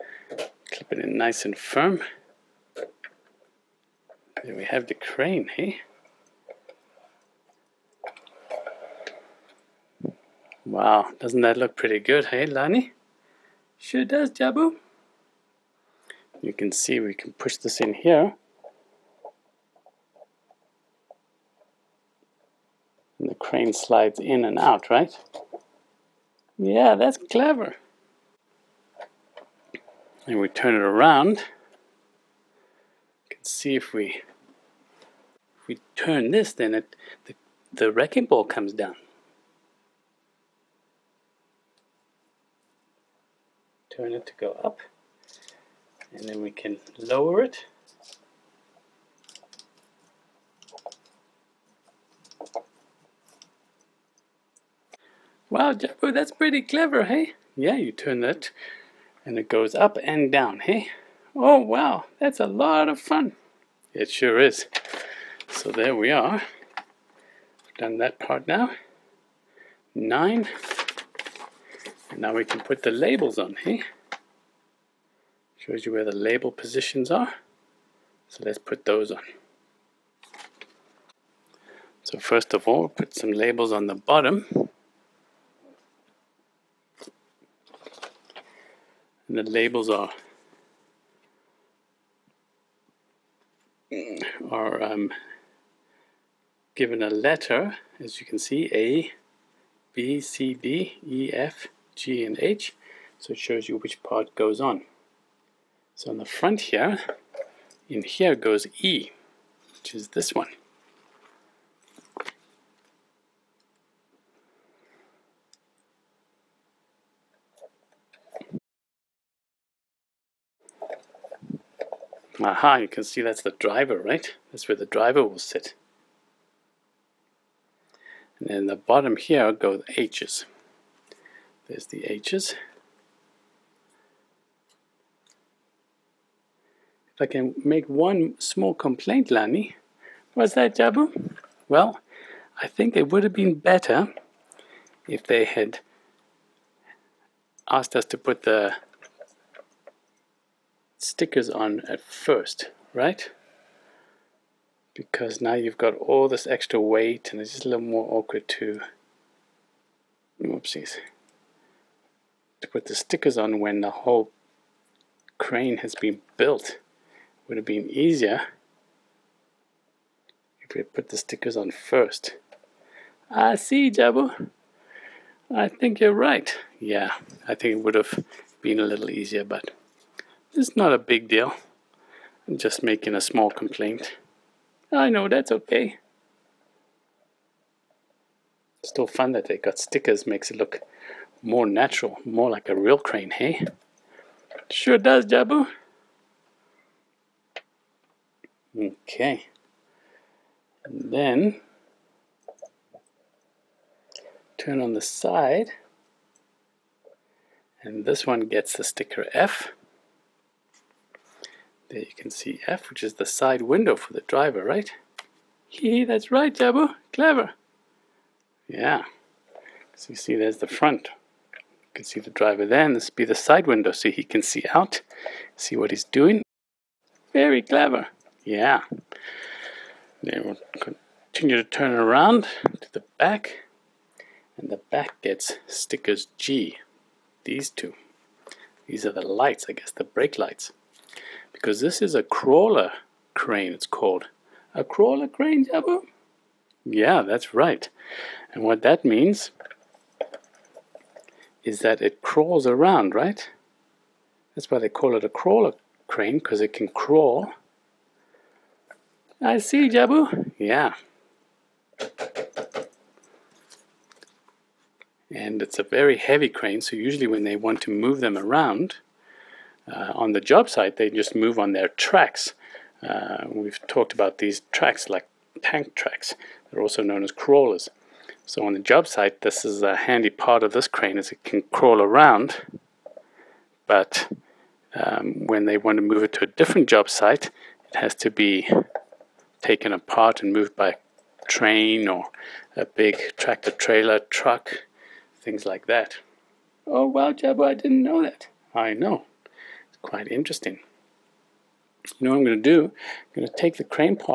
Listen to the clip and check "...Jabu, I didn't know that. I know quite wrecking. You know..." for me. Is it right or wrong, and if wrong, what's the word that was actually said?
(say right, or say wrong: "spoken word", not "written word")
wrong: "interesting", not "wrecking".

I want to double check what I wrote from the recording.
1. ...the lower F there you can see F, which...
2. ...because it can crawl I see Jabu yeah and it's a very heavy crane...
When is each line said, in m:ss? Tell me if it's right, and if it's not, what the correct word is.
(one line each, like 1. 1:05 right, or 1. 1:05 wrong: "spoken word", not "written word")
1. 3:28 wrong: "sticker", not "lower"
2. 4:16 right.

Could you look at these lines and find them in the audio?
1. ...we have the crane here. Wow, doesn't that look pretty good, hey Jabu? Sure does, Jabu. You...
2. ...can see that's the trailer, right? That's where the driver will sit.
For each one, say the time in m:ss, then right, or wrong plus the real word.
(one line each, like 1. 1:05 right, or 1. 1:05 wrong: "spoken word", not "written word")
1. 0:04 wrong: "Lani", not "Jabu"
2. 2:02 wrong: "driver", not "trailer".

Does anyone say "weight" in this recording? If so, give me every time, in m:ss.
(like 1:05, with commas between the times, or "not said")
2:36.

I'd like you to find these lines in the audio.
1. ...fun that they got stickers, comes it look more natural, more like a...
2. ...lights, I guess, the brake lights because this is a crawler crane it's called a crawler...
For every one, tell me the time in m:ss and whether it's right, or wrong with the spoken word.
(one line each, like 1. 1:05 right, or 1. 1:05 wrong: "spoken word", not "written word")
1. 3:09 wrong: "makes", not "comes"
2. 3:59 right.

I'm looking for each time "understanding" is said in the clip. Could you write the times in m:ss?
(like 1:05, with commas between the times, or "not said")
not said.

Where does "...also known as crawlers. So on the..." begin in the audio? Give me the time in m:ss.
4:36.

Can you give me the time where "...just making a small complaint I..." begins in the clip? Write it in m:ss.
3:02.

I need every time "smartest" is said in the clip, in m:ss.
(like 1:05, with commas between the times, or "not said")
not said.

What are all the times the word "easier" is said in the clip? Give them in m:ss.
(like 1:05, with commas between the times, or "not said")
2:47, 2:59.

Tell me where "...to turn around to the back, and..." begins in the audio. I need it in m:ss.
3:51.